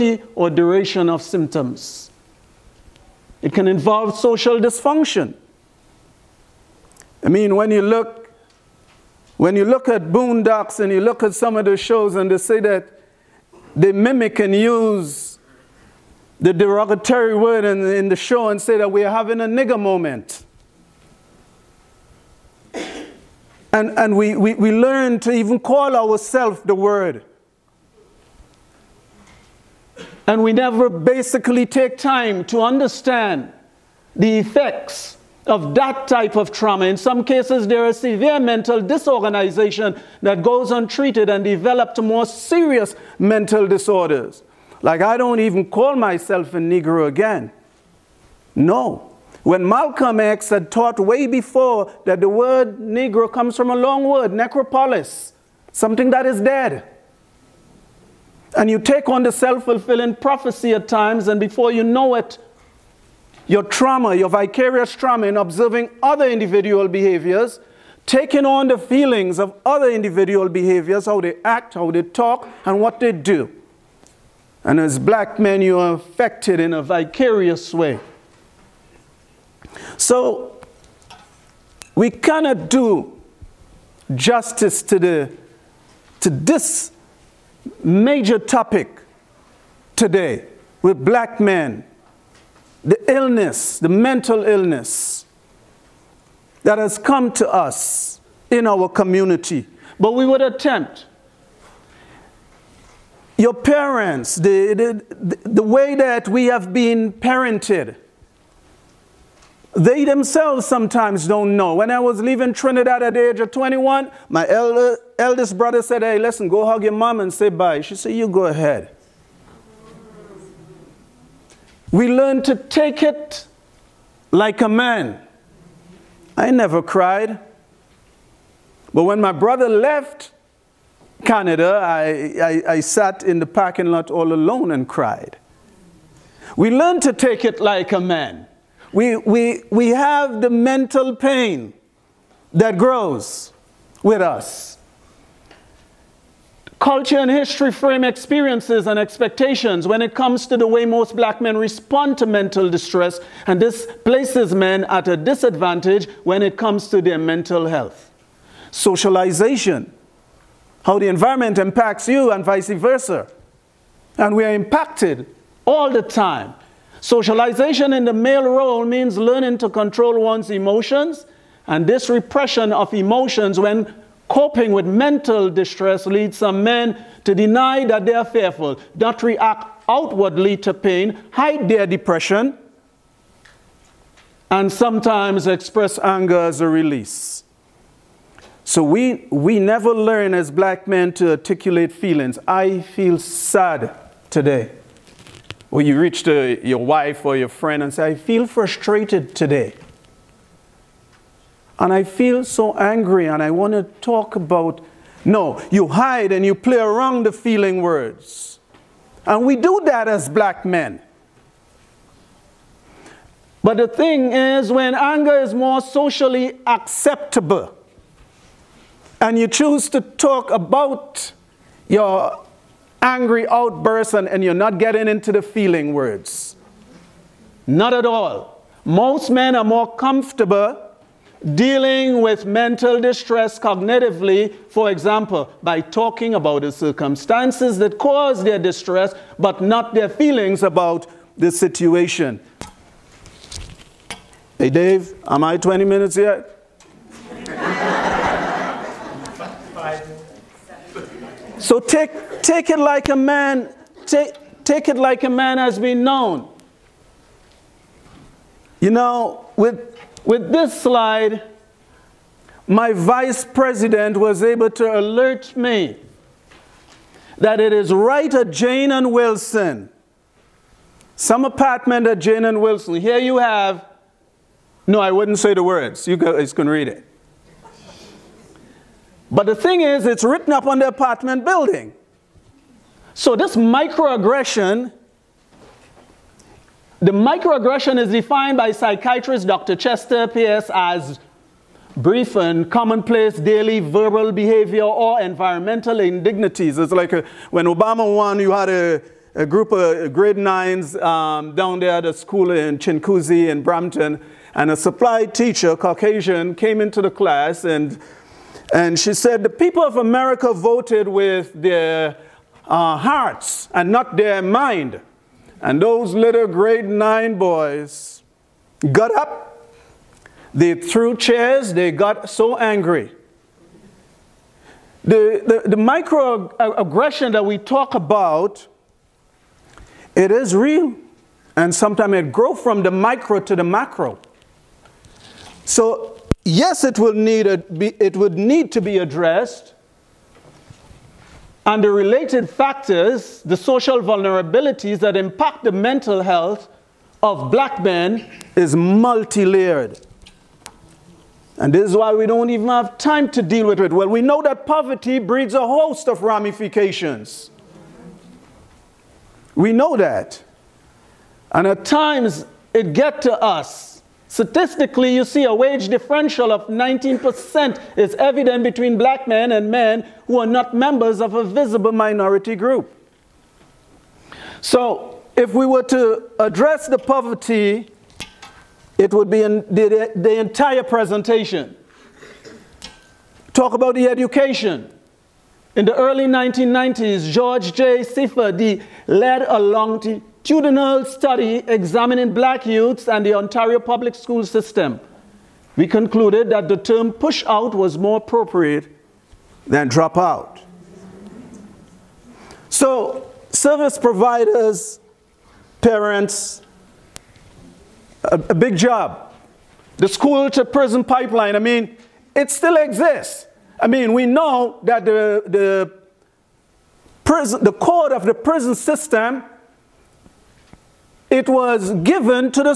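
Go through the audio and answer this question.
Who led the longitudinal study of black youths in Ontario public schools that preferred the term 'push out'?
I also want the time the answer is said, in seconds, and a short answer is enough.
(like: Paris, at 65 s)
George J. Sefa Dei, at 387 s.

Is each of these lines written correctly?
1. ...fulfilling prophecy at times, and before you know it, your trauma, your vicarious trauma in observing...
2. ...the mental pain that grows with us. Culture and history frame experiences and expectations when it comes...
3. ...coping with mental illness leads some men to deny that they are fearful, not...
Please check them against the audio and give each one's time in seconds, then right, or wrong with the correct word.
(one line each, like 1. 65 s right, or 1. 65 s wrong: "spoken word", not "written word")
1. 59 s right
2. 140 s right
3. 174 s wrong: "distress", not "illness".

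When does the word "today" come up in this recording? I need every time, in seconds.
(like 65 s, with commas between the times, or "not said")
89 s, 194 s, 199 s.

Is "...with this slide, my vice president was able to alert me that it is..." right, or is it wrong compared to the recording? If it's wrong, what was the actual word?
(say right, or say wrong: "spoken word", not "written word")
right.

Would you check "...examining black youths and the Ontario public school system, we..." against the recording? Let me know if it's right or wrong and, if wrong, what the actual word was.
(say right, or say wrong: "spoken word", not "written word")
right.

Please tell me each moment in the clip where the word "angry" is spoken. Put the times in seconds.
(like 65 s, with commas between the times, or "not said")
202 s, 223 s, 322 s.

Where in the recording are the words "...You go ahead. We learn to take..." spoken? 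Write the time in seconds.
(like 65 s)
118 s.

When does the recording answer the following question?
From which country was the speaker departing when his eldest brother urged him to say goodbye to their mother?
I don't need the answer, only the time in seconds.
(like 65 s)
112 s.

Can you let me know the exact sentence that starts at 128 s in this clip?
But when my brother left Canada, I, I, I sat in the parking lot all alone and cried.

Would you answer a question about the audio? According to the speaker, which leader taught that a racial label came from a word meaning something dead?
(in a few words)
Malcolm X.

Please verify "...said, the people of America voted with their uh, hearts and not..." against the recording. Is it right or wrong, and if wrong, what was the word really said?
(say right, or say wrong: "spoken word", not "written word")
right.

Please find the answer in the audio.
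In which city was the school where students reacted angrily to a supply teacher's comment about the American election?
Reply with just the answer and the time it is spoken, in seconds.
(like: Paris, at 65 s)
Brampton, at 303 s.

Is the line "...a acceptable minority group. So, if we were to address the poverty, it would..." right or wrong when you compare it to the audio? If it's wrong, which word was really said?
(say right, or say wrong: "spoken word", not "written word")
wrong: "visible", not "acceptable".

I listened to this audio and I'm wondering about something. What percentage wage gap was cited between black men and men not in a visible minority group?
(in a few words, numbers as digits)
19%.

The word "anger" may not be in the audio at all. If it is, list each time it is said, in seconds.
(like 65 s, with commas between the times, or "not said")
185 s, 214 s.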